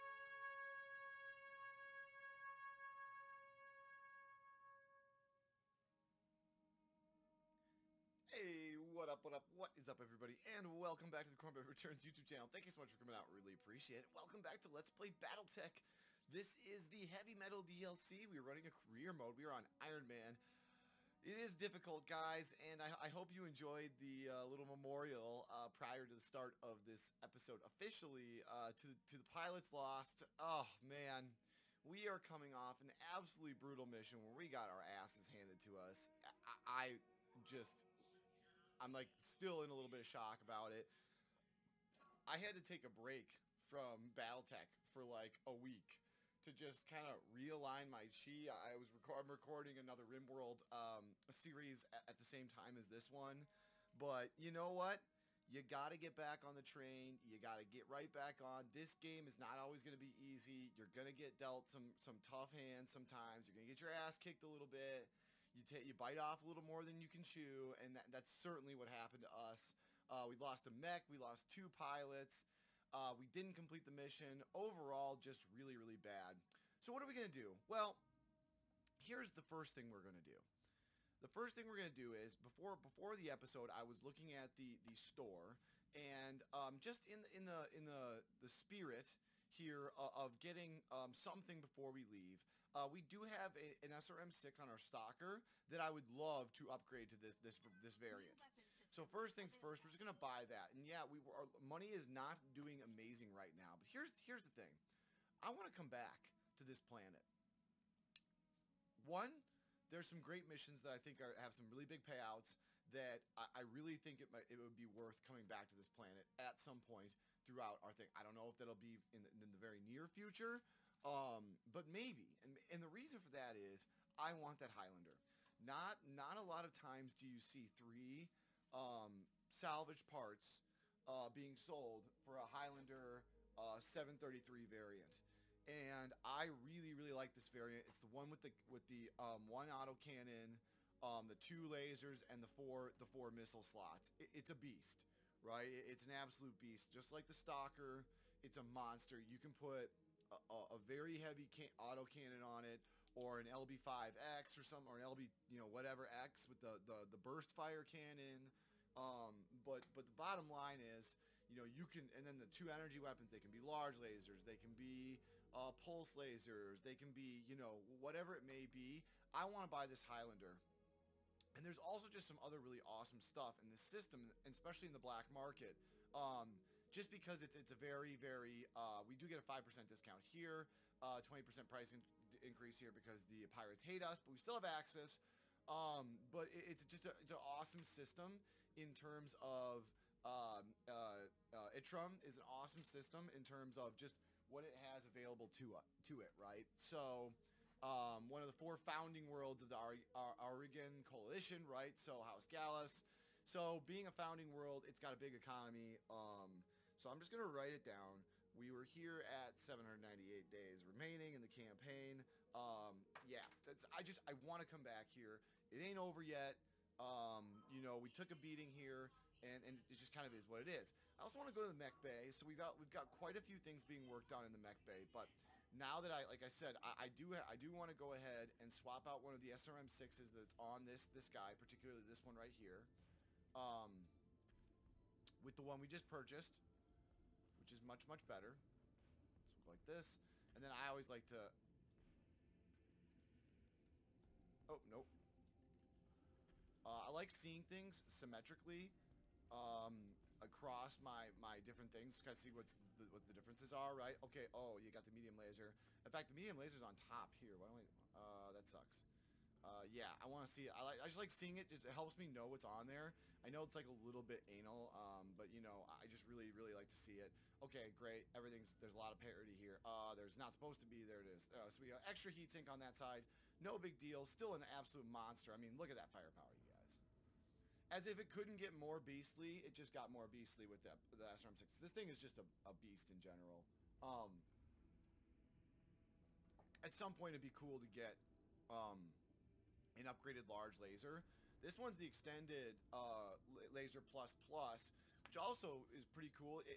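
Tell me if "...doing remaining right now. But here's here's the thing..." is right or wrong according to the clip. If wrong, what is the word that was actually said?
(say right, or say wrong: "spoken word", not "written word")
wrong: "amazing", not "remaining".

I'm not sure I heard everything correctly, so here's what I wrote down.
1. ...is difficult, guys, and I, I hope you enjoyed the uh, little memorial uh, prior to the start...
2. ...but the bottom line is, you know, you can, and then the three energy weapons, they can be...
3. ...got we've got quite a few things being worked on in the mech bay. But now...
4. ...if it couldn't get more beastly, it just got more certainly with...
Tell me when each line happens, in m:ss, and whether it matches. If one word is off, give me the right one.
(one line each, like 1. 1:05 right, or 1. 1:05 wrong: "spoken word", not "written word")
1. 0:21 right
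2. 2:39 wrong: "two", not "three"
3. 3:42 right
4. 4:38 wrong: "beastly", not "certainly".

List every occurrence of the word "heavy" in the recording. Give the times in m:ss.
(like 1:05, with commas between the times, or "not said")
0:17, 2:31.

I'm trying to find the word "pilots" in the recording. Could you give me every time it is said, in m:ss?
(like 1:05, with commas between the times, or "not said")
0:29, 1:11.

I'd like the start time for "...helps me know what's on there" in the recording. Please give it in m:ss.
4:21.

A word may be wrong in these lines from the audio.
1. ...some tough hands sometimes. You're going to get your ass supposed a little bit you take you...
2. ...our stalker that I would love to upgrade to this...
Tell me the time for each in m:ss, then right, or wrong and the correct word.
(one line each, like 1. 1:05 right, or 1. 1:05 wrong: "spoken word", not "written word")
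1. 1:01 wrong: "kicked", not "supposed"
2. 1:34 right.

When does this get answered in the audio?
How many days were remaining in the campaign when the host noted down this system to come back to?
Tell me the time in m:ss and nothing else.
3:29.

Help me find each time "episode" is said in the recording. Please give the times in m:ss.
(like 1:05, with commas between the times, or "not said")
0:27, 1:23.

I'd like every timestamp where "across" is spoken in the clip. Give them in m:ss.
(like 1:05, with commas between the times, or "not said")
4:10.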